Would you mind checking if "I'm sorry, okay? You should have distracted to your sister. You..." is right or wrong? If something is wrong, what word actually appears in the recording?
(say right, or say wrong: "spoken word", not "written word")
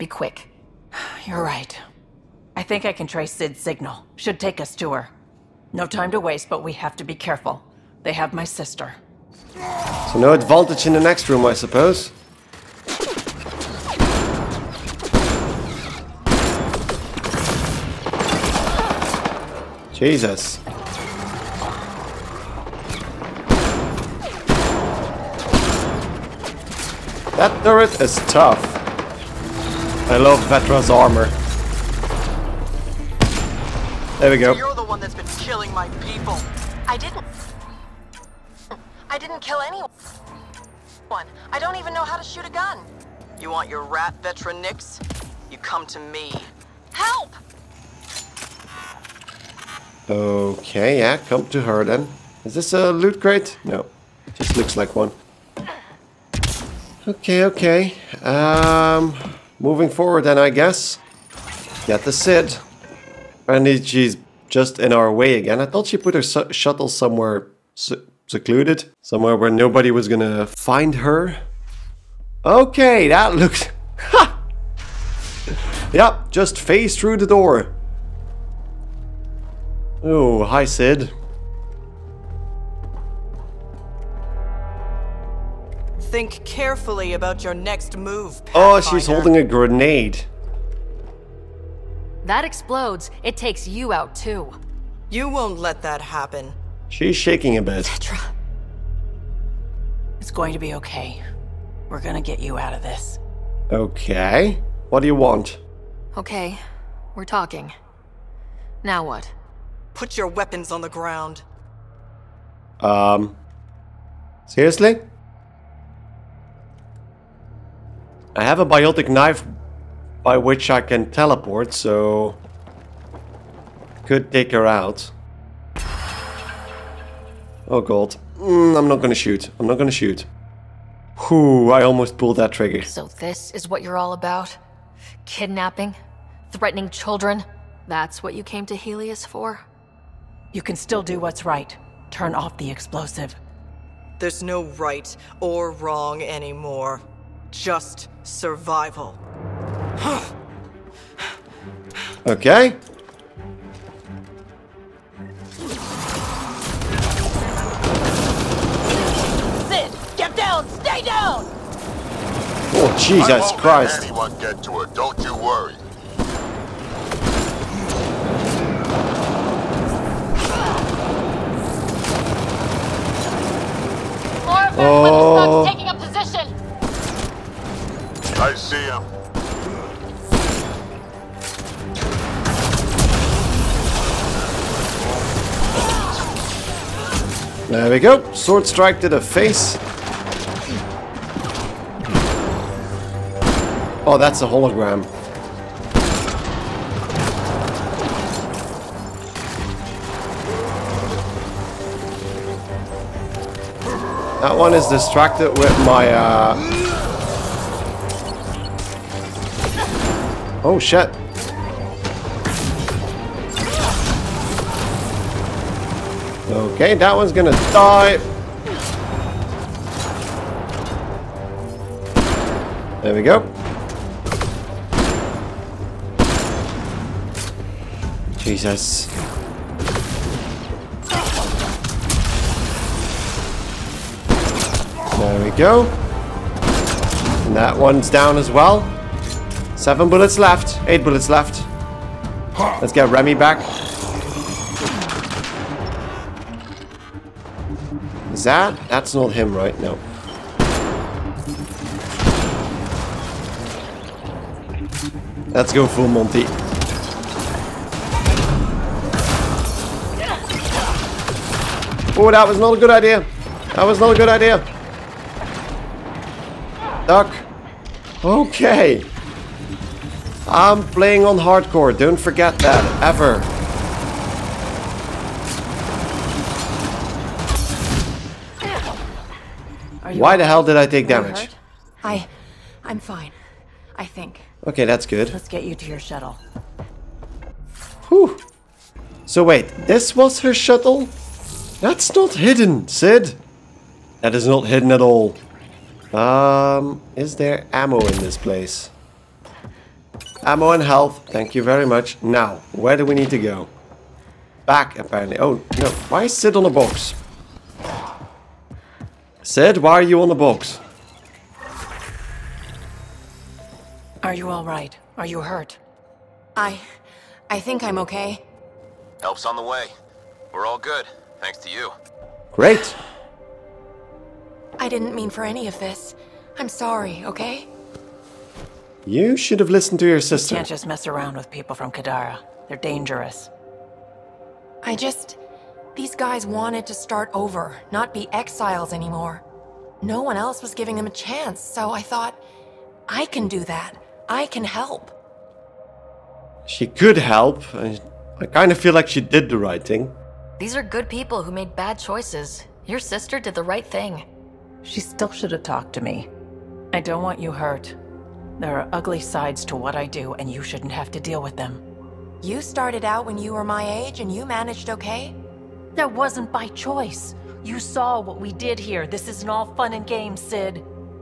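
wrong: "listened", not "distracted".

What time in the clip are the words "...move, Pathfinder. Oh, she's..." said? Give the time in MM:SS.
01:27.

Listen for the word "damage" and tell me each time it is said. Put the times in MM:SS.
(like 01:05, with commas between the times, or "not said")
04:41.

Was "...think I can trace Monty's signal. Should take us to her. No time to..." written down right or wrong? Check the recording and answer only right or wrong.
wrong.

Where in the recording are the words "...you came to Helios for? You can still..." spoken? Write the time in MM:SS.
02:18.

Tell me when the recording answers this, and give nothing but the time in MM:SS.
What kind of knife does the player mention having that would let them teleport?
01:58.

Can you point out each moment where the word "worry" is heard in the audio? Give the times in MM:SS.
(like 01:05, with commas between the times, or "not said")
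02:45.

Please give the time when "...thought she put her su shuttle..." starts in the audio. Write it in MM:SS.
01:05.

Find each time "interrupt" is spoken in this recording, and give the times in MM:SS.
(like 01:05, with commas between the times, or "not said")
not said.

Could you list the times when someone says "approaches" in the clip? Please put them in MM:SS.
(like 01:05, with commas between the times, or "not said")
not said.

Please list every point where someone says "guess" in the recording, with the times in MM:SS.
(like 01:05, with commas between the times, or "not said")
01:00.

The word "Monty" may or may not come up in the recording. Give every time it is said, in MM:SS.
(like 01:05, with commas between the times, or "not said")
04:16.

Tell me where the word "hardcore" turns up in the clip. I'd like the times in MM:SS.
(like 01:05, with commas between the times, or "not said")
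04:31.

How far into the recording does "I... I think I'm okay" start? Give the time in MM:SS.
05:16.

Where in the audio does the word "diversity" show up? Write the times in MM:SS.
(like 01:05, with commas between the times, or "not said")
not said.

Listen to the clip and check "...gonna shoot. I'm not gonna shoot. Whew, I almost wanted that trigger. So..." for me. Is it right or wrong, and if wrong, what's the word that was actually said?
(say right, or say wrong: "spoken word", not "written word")
wrong: "pulled", not "wanted".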